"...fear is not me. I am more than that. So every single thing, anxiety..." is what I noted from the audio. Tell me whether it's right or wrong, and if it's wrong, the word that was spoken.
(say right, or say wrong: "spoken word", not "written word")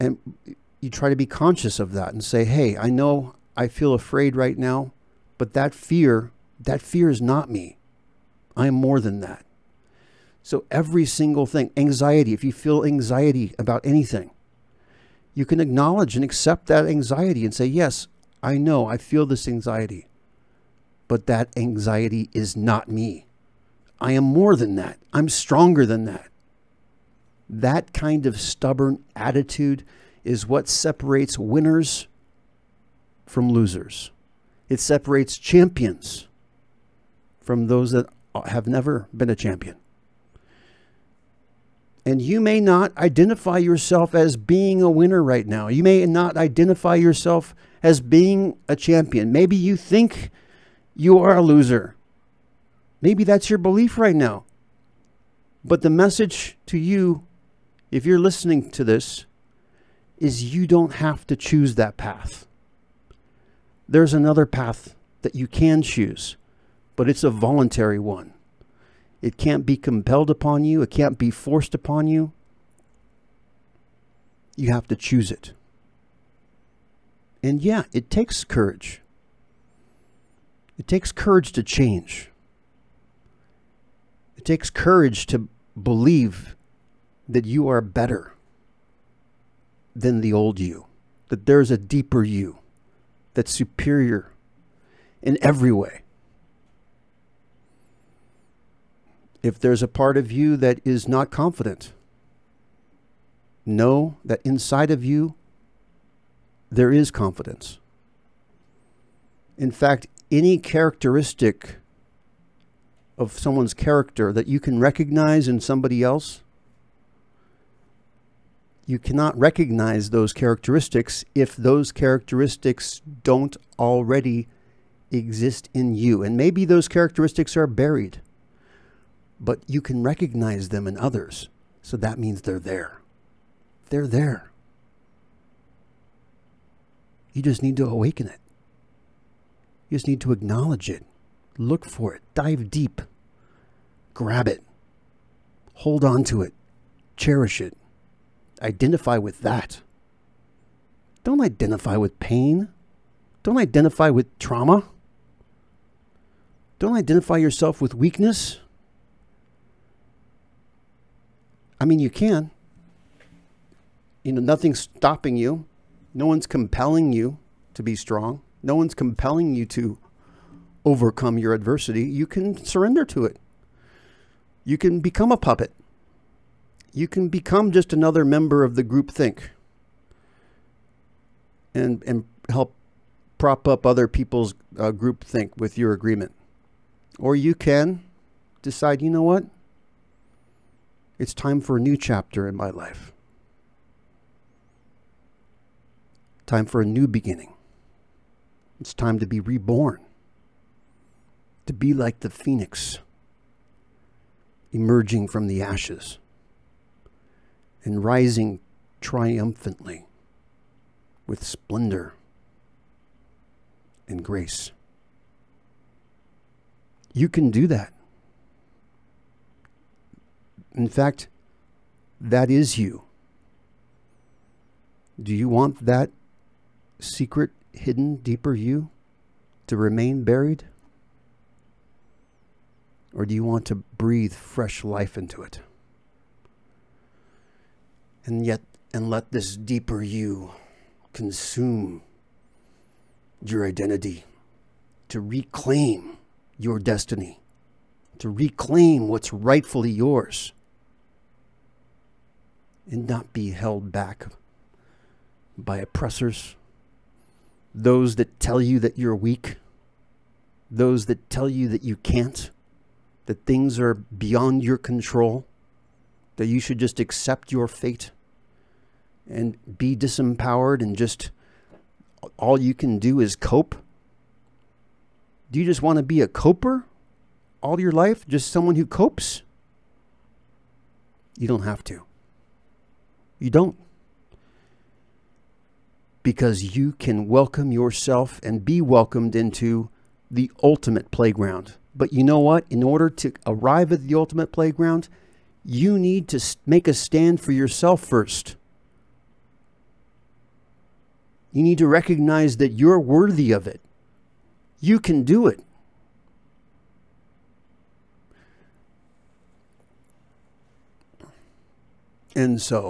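right.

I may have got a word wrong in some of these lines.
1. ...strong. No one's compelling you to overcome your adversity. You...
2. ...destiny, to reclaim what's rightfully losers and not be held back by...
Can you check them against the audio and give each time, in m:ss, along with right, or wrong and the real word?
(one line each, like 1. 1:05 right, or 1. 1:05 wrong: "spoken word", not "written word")
1. 2:47 right
2. 4:06 wrong: "yours", not "losers".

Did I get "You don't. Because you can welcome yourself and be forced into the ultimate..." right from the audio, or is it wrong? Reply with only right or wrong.
wrong.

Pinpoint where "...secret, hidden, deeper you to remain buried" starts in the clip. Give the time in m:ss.
3:46.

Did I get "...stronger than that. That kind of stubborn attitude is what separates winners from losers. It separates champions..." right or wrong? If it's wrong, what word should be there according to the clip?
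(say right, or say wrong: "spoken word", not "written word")
right.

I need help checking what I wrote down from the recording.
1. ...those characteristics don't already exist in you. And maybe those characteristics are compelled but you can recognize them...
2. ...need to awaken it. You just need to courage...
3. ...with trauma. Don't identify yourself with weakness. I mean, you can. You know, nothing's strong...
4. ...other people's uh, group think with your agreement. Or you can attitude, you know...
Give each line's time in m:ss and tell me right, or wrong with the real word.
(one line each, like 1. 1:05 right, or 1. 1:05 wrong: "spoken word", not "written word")
1. 2:01 wrong: "buried", not "compelled"
2. 2:17 wrong: "acknowledge", not "courage"
3. 2:34 wrong: "stopping", not "strong"
4. 3:03 wrong: "decide", not "attitude".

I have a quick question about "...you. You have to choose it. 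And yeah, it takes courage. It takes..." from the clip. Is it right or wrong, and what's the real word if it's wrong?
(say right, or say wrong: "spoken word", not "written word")
right.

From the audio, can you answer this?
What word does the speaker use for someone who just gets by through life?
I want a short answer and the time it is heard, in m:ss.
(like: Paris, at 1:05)
a coper, at 4:36.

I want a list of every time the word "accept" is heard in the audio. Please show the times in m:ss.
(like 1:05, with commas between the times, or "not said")
0:16, 4:26.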